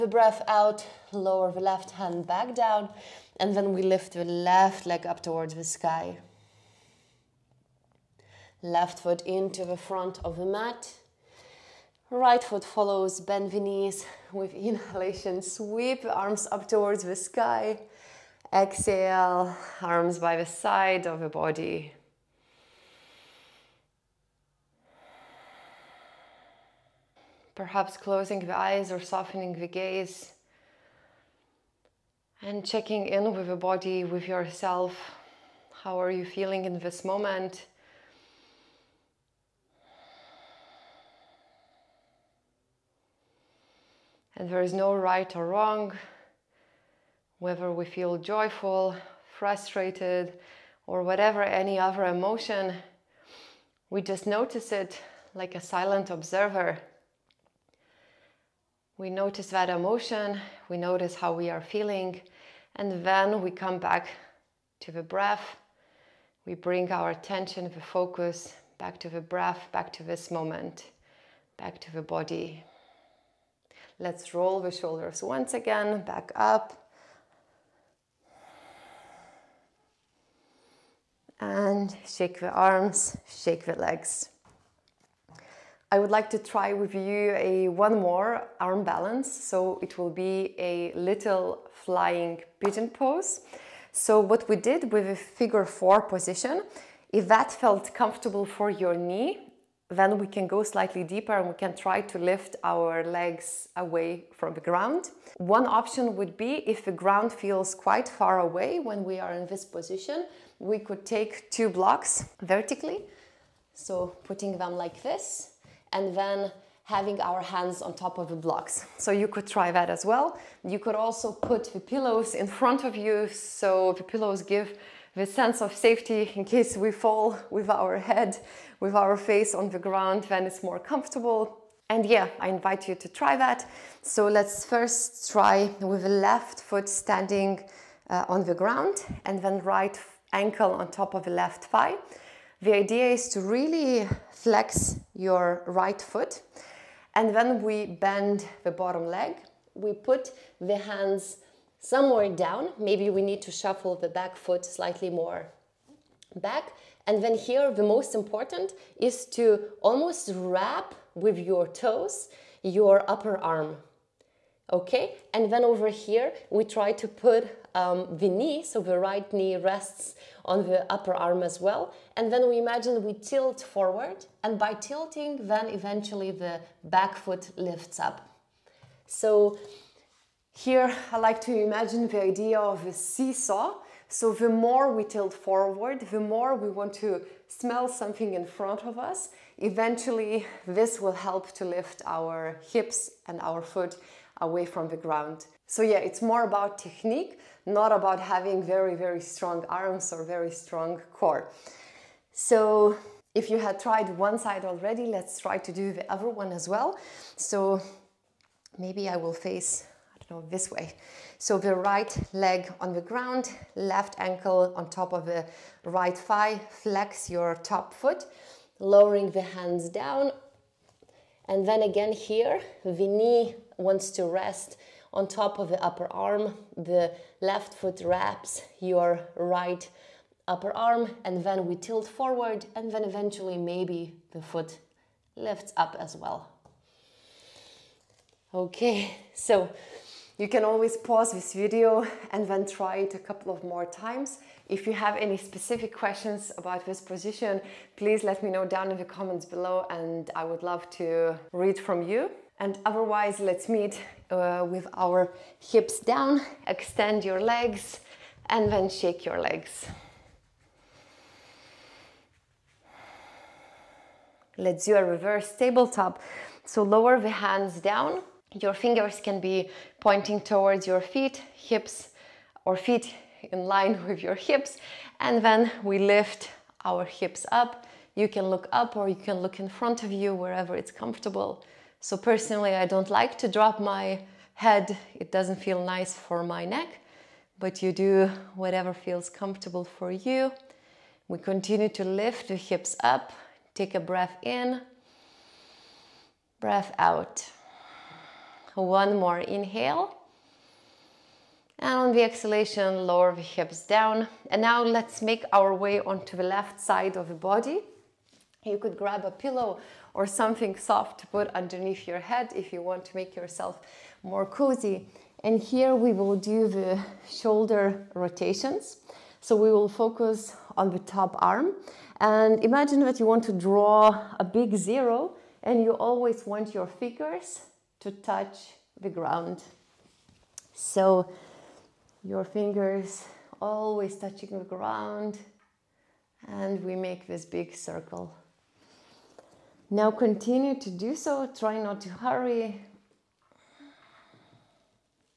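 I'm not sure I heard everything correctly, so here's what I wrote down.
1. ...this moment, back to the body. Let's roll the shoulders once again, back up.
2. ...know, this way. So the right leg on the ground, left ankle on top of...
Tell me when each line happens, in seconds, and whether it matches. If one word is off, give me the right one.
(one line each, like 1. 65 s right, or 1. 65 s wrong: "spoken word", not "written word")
1. 70 s right
2. 210 s right.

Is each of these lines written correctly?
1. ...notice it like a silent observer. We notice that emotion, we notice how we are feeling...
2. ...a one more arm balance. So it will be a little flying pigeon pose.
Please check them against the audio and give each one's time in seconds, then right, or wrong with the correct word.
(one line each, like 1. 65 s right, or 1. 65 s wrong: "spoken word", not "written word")
1. 54 s right
2. 87 s right.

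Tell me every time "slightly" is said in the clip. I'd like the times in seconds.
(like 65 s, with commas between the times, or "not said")
100 s, 154 s.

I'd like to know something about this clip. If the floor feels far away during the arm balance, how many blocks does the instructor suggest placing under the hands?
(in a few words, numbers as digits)
2.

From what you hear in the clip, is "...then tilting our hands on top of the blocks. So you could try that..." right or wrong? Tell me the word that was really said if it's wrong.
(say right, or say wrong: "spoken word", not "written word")
wrong: "having", not "tilting".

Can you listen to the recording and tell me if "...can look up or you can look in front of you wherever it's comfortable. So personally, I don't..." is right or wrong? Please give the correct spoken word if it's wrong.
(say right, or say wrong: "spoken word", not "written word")
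right.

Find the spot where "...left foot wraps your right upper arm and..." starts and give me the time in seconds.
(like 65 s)
227 s.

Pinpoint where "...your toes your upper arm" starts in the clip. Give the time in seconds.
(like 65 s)
161 s.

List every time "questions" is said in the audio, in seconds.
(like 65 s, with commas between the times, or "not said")
245 s.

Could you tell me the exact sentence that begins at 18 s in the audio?
Exhale, arms by the side of the body.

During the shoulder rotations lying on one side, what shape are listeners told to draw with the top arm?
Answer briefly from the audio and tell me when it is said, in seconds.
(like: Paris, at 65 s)
A big zero, at 324 s.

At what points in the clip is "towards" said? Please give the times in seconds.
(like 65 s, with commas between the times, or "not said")
5 s, 16 s, 270 s.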